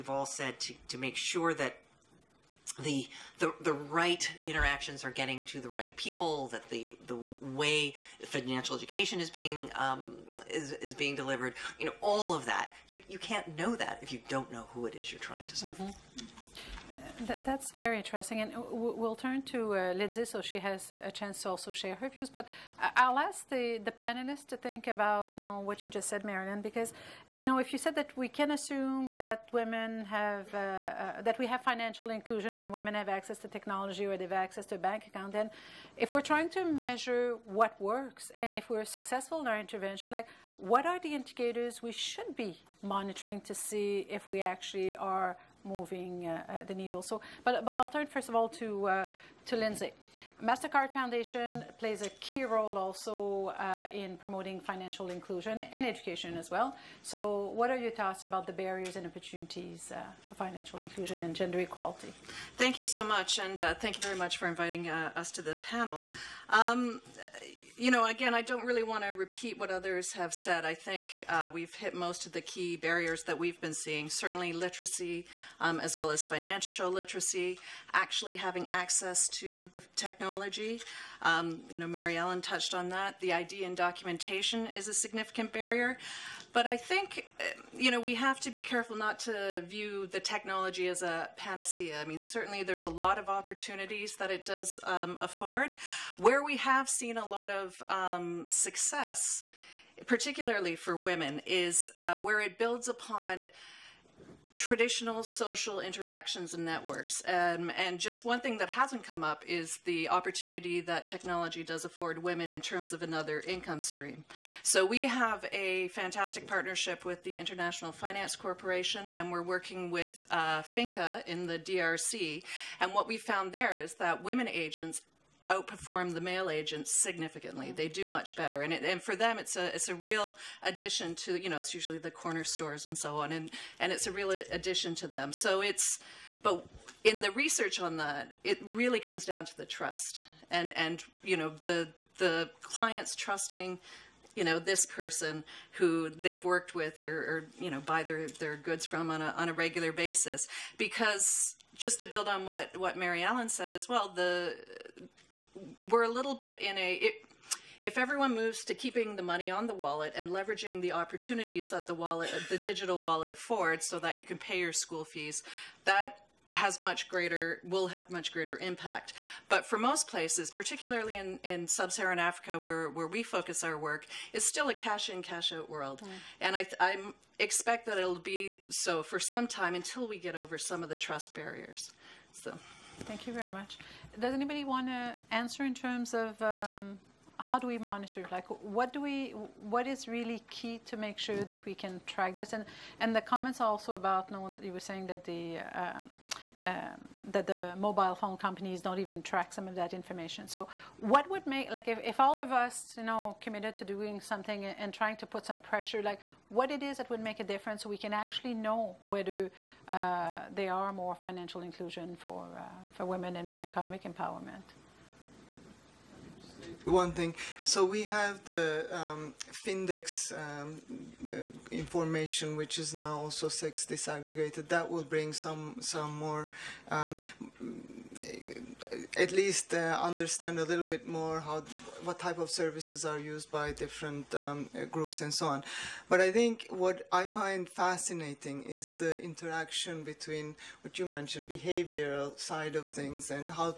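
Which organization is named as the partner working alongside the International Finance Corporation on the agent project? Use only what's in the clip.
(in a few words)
FINCA.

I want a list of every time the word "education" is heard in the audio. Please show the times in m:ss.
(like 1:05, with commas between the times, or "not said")
0:08, 0:55.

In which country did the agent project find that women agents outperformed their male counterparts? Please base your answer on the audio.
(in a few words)
DRC.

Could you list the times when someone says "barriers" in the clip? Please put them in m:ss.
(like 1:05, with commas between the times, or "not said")
0:58, 1:12, 1:25, 3:01.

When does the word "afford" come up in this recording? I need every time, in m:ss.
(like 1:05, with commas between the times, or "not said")
1:35, 1:51, 2:43.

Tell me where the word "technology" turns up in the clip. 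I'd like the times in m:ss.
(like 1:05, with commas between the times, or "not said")
0:33, 1:19, 1:30, 1:51.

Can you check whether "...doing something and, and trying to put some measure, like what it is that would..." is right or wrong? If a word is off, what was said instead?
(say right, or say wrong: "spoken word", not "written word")
wrong: "pressure", not "measure".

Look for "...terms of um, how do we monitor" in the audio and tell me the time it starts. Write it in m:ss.
3:05.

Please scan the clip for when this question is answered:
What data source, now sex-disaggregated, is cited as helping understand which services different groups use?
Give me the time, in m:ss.
3:39.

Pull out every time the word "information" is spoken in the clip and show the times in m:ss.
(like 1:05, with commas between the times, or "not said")
3:19, 3:41.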